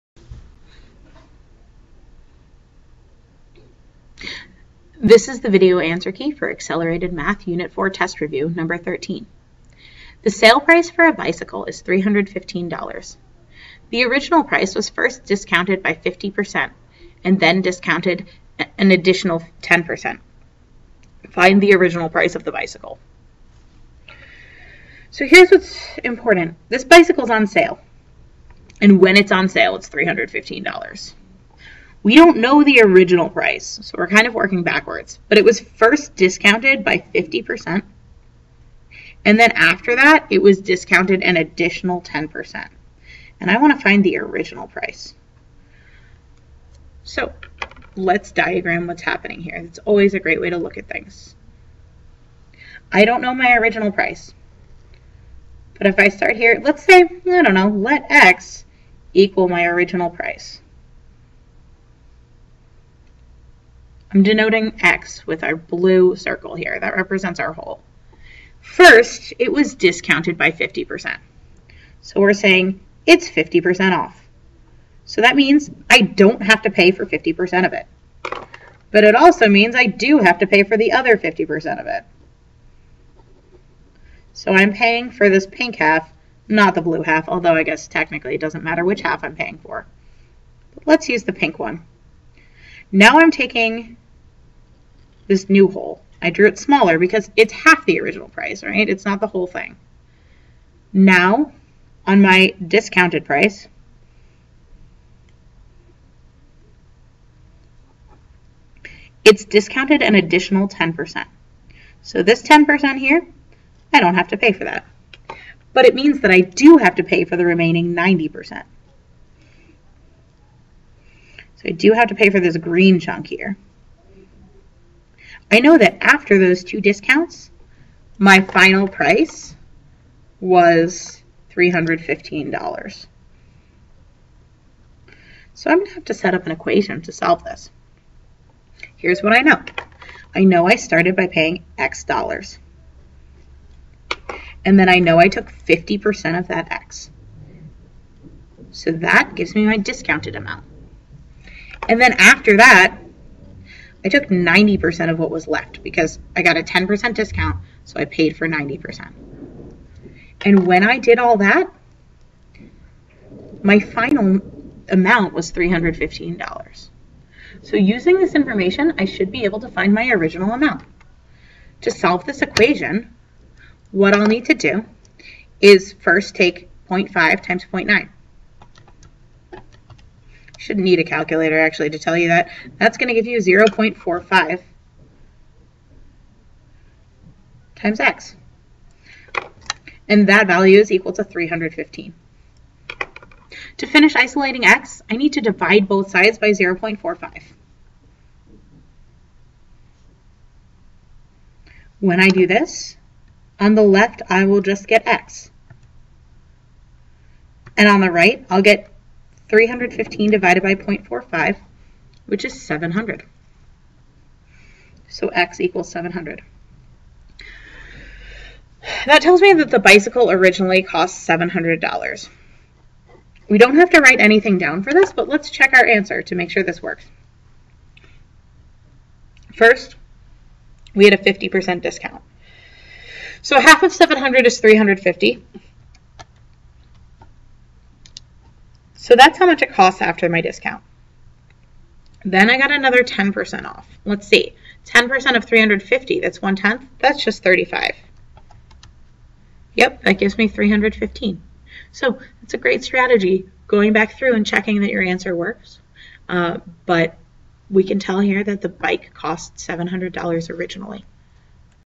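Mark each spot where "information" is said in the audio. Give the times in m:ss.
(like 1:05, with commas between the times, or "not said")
2:48.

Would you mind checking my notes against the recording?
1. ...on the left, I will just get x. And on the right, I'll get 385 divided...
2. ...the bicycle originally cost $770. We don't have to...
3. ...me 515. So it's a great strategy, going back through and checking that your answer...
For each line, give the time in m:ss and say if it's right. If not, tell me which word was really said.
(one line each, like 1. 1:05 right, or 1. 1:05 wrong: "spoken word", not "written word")
1. 3:23 wrong: "315", not "385"
2. 3:39 wrong: "700", not "770"
3. 4:10 wrong: "315", not "515".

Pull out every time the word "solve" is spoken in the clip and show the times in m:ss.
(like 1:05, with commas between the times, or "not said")
2:17, 2:51.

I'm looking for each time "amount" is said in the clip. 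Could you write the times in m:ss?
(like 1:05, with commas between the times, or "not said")
2:30, 2:44, 2:50.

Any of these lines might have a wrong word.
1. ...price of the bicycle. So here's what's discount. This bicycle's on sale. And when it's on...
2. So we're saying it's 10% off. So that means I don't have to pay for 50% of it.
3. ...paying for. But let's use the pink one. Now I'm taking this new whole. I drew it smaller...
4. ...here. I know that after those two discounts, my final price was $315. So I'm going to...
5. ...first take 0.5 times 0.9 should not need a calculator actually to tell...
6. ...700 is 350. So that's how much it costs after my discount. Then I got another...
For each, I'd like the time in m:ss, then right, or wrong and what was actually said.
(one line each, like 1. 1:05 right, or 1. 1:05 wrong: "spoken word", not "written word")
1. 0:22 wrong: "important", not "discount"
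2. 1:12 wrong: "50", not "10"
3. 1:29 right
4. 2:03 right
5. 2:55 right
6. 3:53 right.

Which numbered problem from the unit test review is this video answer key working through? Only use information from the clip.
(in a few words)
13.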